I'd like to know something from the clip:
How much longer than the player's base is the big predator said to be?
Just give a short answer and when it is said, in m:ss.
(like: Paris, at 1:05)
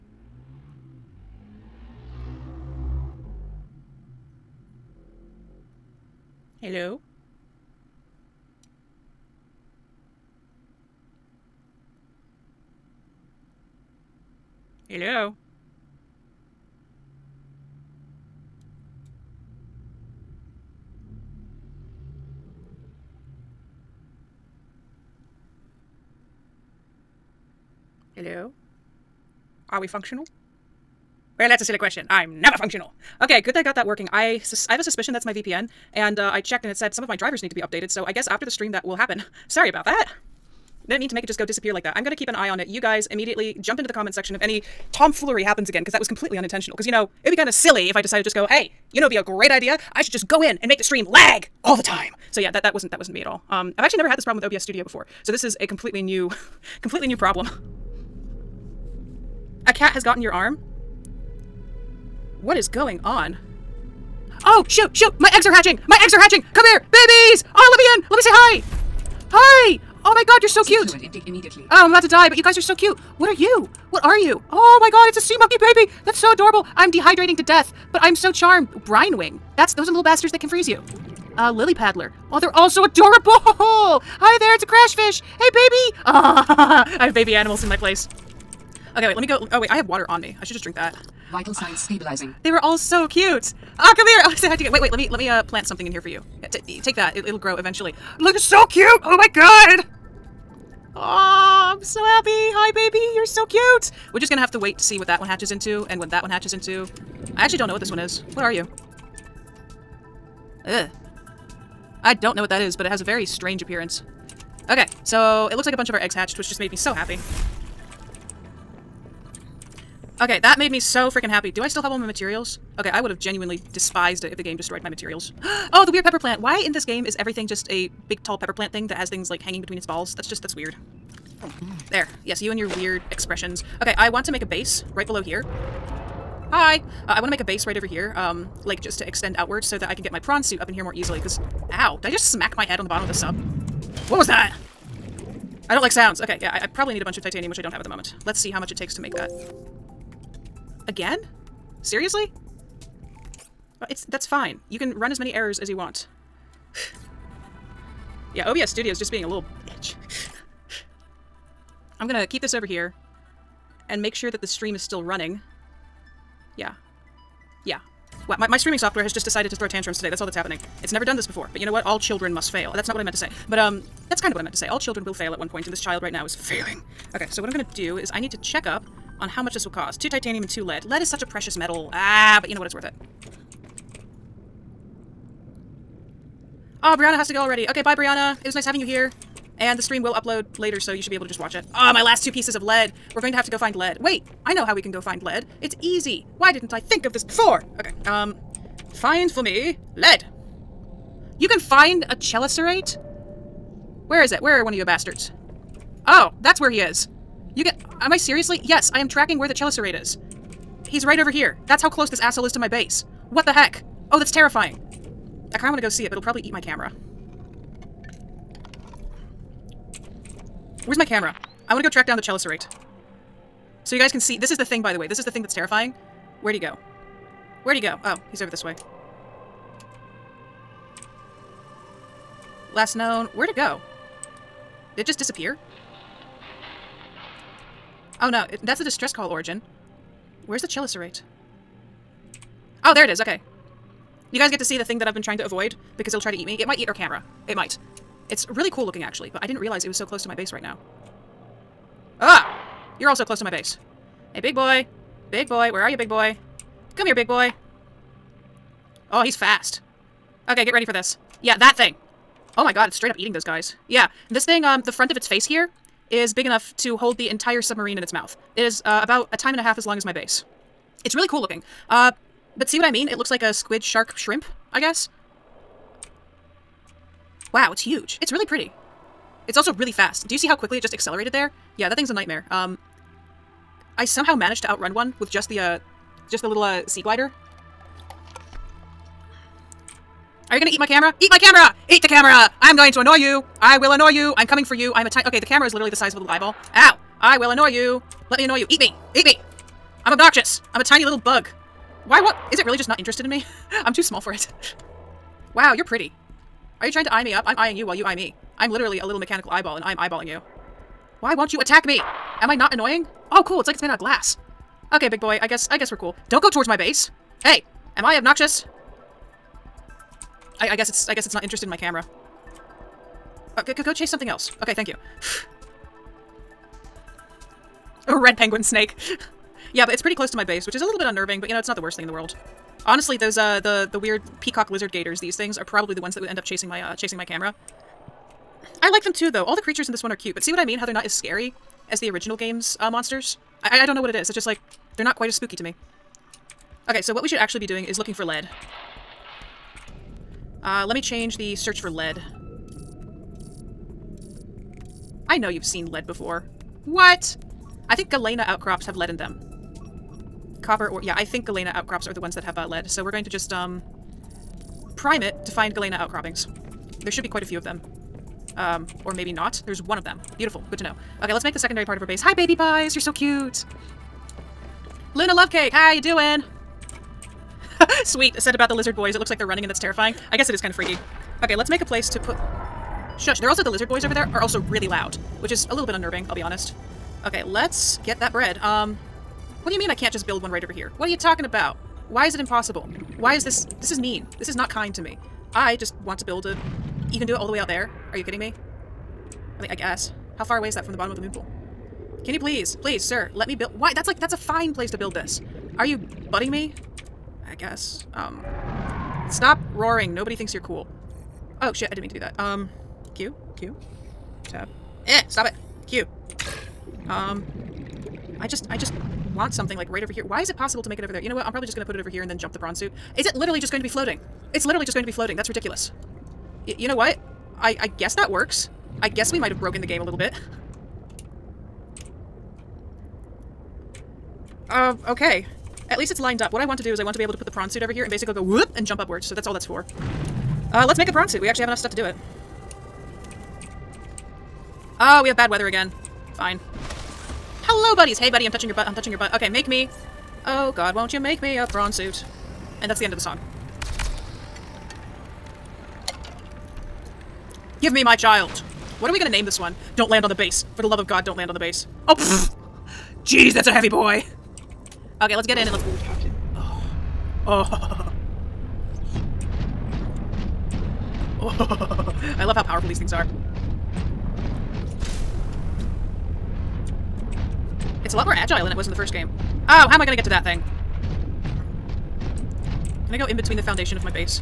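A time and a half, at 4:29.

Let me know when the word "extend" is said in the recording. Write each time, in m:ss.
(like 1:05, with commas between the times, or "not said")
2:19.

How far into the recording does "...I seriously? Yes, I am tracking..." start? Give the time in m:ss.
3:28.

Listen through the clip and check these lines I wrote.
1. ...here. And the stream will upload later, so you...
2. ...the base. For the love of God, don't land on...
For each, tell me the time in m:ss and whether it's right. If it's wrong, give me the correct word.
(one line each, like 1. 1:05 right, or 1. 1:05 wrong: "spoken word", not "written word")
1. 3:08 right
2. 7:40 right.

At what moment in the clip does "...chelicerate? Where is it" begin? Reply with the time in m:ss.
3:22.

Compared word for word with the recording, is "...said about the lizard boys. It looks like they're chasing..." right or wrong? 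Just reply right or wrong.
wrong.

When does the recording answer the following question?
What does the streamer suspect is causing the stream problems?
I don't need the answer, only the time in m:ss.
0:35.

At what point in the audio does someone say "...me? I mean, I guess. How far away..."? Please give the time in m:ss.
6:38.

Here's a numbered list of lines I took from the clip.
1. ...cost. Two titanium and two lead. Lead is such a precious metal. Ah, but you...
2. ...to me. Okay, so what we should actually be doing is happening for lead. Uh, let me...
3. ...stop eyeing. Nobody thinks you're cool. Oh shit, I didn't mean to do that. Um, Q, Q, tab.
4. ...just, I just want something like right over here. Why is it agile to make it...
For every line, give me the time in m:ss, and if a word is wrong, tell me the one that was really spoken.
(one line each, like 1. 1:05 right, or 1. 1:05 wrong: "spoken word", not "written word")
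1. 2:59 right
2. 5:45 wrong: "looking", not "happening"
3. 6:49 wrong: "roaring", not "eyeing"
4. 6:58 wrong: "possible", not "agile".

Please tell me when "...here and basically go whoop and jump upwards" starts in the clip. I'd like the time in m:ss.
7:17.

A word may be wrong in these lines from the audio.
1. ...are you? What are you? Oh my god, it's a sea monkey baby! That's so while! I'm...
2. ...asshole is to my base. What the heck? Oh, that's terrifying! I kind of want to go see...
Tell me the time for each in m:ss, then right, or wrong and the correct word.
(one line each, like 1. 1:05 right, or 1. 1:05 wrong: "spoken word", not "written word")
1. 1:13 wrong: "adorable", not "while"
2. 3:32 right.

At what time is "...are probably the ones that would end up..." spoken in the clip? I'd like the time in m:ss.
5:35.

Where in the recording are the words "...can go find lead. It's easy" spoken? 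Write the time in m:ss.
3:14.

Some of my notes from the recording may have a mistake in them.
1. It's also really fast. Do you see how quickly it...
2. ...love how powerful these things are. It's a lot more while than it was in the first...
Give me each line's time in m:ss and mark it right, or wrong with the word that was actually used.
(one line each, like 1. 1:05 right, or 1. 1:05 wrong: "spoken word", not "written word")
1. 4:39 right
2. 7:52 wrong: "agile", not "while".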